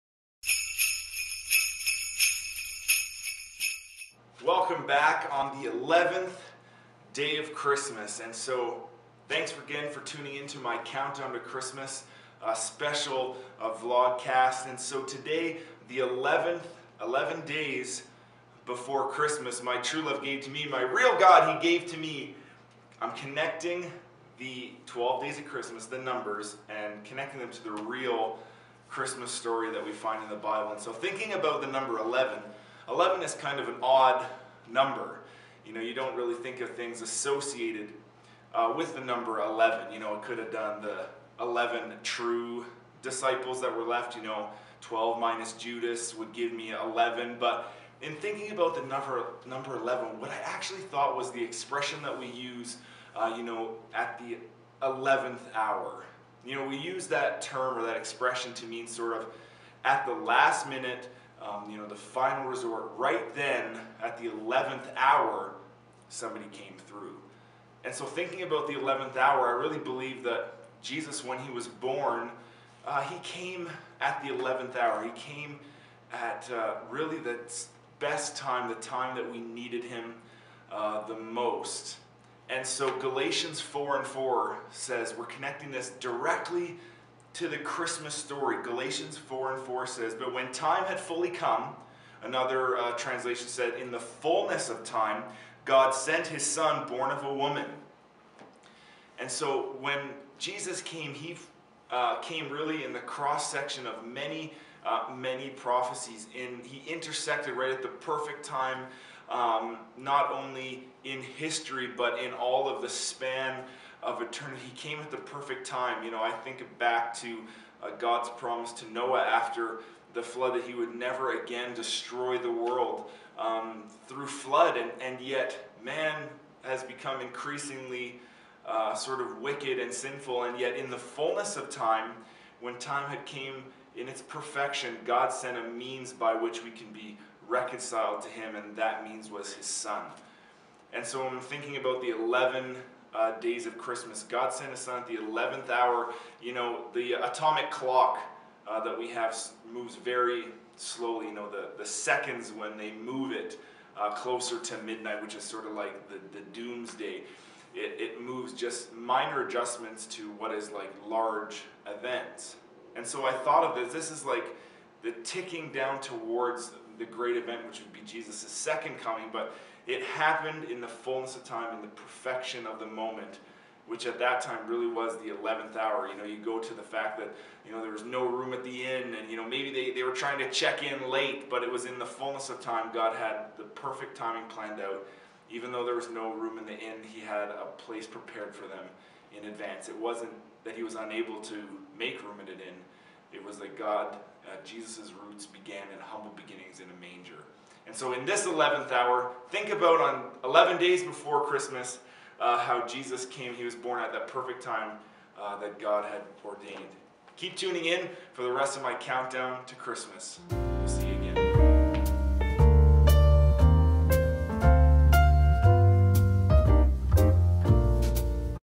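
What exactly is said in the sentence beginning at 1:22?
And so Galatians 4 and 4 says, we're connecting this directly to the Christmas story.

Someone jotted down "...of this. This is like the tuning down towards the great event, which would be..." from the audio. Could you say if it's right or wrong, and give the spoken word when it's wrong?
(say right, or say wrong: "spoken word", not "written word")
wrong: "ticking", not "tuning".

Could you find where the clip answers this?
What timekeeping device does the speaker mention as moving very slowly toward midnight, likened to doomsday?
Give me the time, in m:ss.
2:27.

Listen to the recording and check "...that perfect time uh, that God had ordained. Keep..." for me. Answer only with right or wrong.
right.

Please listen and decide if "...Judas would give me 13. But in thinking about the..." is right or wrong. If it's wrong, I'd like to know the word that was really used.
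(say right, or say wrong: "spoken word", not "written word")
wrong: "11", not "13".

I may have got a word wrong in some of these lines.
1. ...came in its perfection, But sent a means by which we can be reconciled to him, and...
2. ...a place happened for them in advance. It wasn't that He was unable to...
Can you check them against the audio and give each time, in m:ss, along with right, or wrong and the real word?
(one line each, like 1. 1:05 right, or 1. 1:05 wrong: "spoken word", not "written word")
1. 2:13 wrong: "God", not "But"
2. 3:07 wrong: "prepared", not "happened".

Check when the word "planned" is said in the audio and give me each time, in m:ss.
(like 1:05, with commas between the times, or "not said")
3:04.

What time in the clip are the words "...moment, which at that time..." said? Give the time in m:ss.
2:52.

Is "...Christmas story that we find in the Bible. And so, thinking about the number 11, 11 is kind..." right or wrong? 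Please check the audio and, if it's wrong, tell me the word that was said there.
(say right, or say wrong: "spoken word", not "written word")
right.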